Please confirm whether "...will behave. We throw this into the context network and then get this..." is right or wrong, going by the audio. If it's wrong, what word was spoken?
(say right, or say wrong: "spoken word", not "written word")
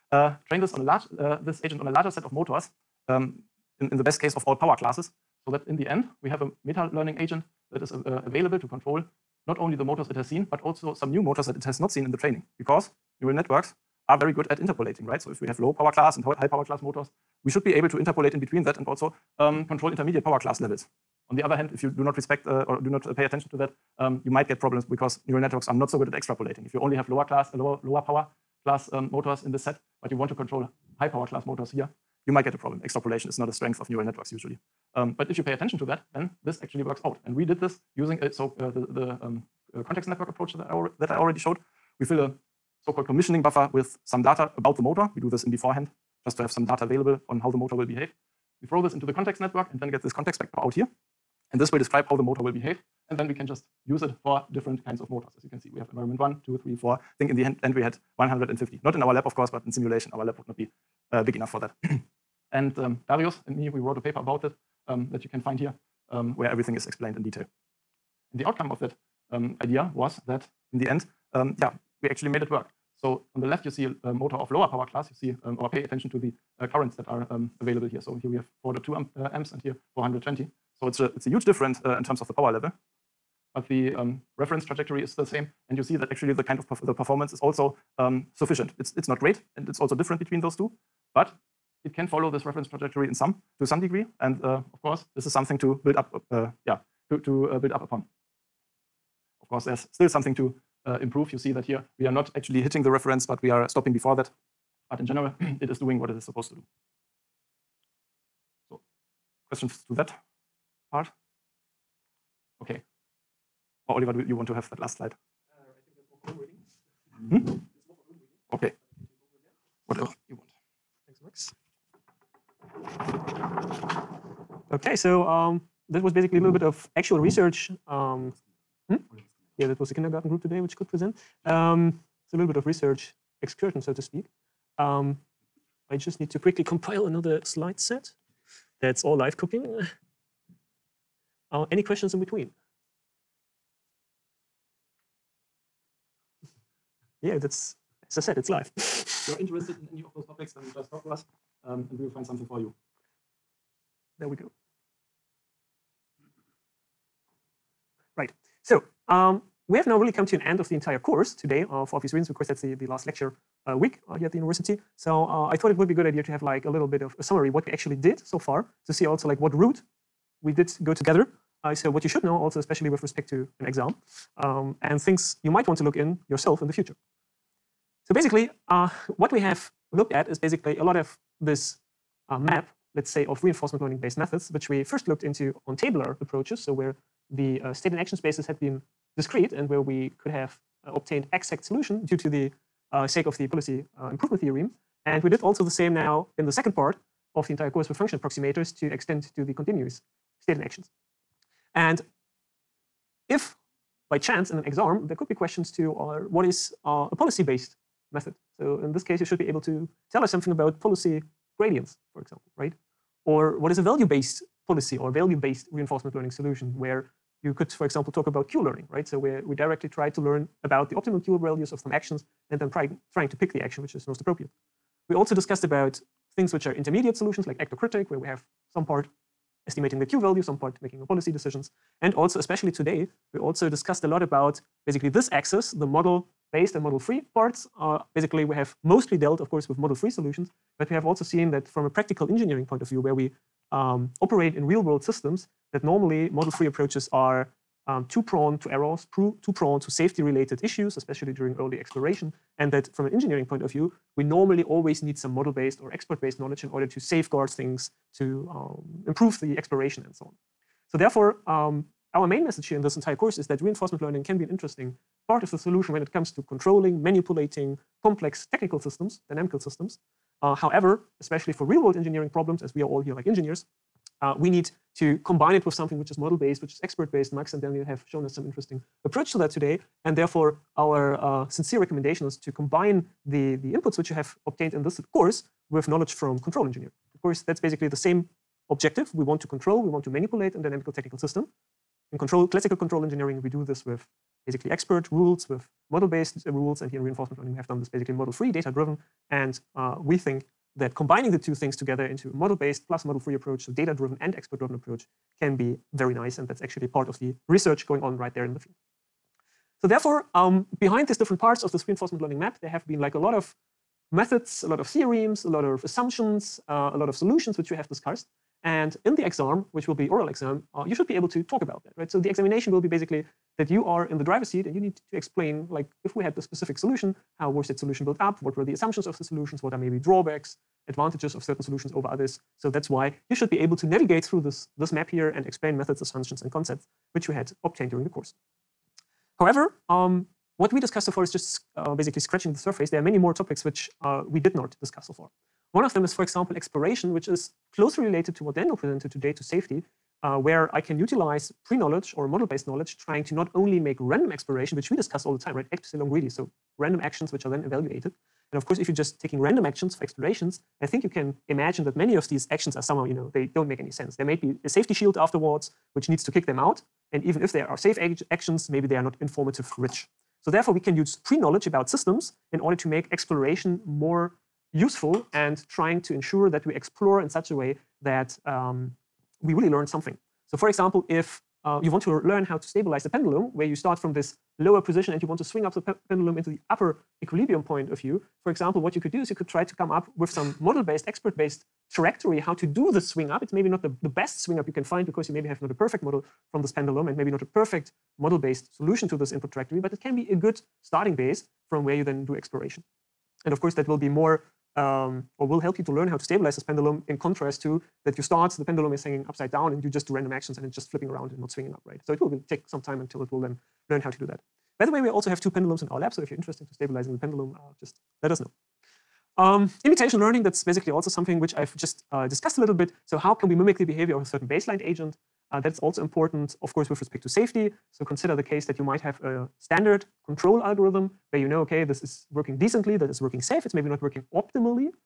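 right.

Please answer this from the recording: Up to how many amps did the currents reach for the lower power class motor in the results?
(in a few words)
4.2 amps.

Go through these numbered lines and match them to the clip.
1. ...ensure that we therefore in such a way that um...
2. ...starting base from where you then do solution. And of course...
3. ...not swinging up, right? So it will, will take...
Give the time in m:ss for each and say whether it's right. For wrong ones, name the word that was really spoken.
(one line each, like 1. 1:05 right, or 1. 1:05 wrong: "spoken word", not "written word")
1. 6:16 wrong: "explore", not "therefore"
2. 6:40 wrong: "exploration", not "solution"
3. 6:51 right.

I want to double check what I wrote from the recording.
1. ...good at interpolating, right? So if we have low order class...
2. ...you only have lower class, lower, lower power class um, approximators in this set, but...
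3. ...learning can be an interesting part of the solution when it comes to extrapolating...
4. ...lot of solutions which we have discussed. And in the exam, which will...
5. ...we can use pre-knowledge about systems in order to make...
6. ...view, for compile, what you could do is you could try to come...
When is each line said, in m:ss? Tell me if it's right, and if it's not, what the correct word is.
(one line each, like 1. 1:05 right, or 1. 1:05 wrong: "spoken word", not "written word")
1. 0:14 wrong: "power", not "order"
2. 0:26 wrong: "motors", not "approximators"
3. 4:24 wrong: "controlling", not "extrapolating"
4. 5:16 right
5. 6:10 right
6. 6:27 wrong: "example", not "compile".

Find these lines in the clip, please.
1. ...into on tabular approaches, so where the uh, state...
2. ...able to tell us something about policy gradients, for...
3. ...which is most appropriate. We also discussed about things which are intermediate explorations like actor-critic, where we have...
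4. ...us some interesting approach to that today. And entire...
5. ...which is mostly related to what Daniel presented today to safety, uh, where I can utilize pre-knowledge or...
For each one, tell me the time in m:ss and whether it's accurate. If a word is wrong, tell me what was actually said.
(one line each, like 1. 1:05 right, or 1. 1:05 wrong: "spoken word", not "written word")
1. 3:05 right
2. 3:29 right
3. 3:43 wrong: "solutions", not "explorations"
4. 4:38 wrong: "therefore", not "entire"
5. 5:47 wrong: "closely", not "mostly".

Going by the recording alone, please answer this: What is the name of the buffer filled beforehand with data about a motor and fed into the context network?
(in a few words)
commissioning buffer.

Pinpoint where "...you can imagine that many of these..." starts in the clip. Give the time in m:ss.
6:01.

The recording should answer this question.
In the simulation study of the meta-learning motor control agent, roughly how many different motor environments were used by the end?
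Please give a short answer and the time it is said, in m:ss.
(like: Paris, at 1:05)
150, at 0:58.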